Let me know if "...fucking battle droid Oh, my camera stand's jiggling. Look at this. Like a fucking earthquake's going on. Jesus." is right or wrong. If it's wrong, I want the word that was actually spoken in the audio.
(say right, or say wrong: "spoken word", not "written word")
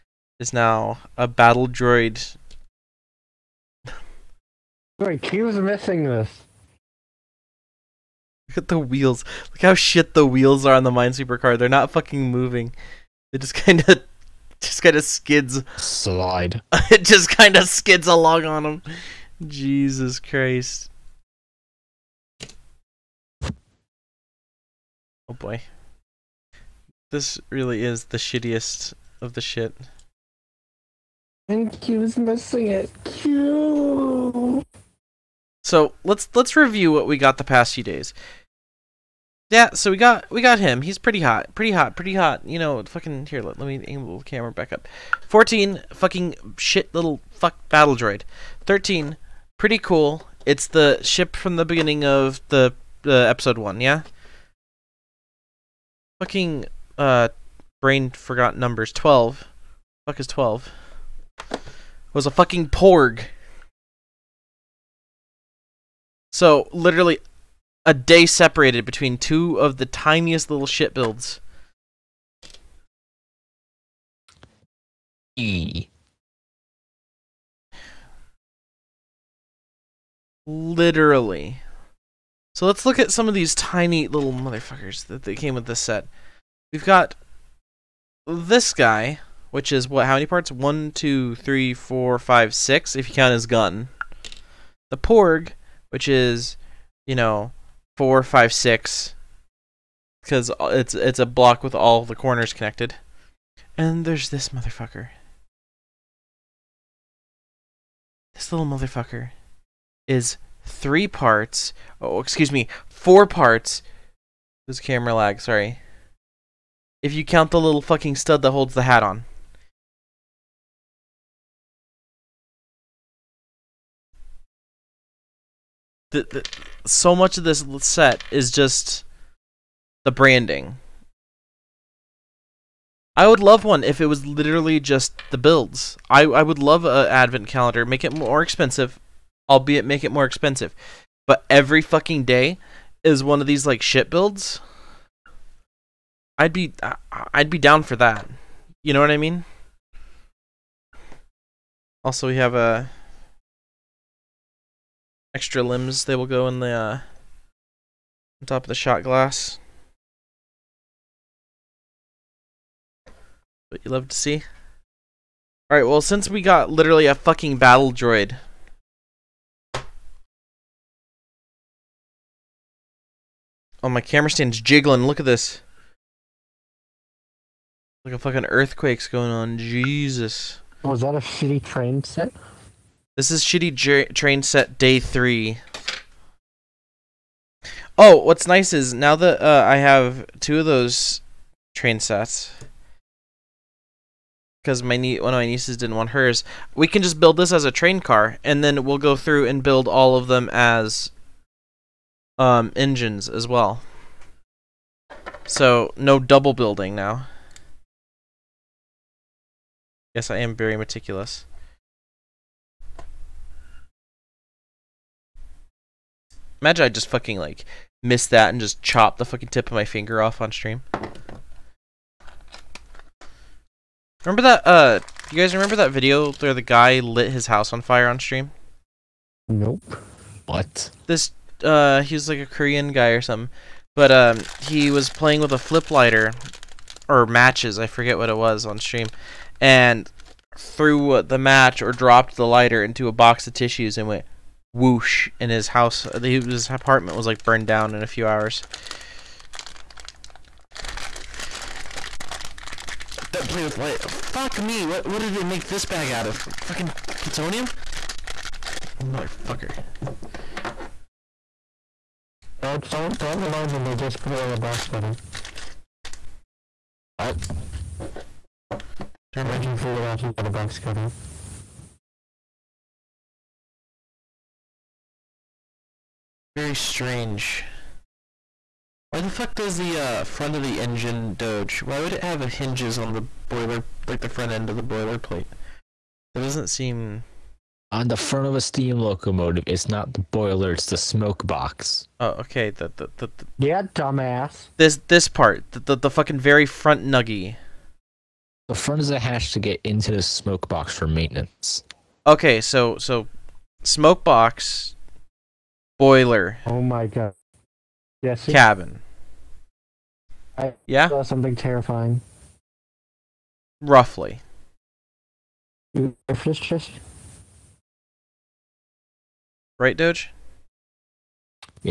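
right.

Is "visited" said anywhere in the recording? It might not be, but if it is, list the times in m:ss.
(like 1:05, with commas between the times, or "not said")
not said.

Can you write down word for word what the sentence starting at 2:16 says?
I, I would love an advent calendar.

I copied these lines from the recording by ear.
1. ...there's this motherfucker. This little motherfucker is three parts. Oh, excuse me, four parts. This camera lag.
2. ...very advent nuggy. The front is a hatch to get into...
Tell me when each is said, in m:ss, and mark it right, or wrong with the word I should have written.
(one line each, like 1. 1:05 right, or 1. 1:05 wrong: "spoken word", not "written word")
1. 1:44 right
2. 4:56 wrong: "front", not "advent".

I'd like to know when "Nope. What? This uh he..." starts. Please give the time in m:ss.
3:49.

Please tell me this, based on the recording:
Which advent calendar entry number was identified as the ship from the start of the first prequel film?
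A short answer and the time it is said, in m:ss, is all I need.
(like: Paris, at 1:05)
13, at 0:48.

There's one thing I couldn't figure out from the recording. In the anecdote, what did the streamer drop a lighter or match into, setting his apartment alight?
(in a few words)
A box of tissues.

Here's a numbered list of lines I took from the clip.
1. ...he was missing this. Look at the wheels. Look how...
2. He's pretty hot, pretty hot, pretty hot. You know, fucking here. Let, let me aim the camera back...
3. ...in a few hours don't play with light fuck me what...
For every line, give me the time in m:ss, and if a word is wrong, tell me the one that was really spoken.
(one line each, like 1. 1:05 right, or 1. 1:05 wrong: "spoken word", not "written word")
1. 0:05 right
2. 0:40 right
3. 4:07 right.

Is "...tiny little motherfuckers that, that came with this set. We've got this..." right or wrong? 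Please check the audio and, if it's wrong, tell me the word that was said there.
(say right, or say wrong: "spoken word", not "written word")
right.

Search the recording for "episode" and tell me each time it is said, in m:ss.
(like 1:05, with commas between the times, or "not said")
0:53.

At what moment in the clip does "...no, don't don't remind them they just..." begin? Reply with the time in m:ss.
4:22.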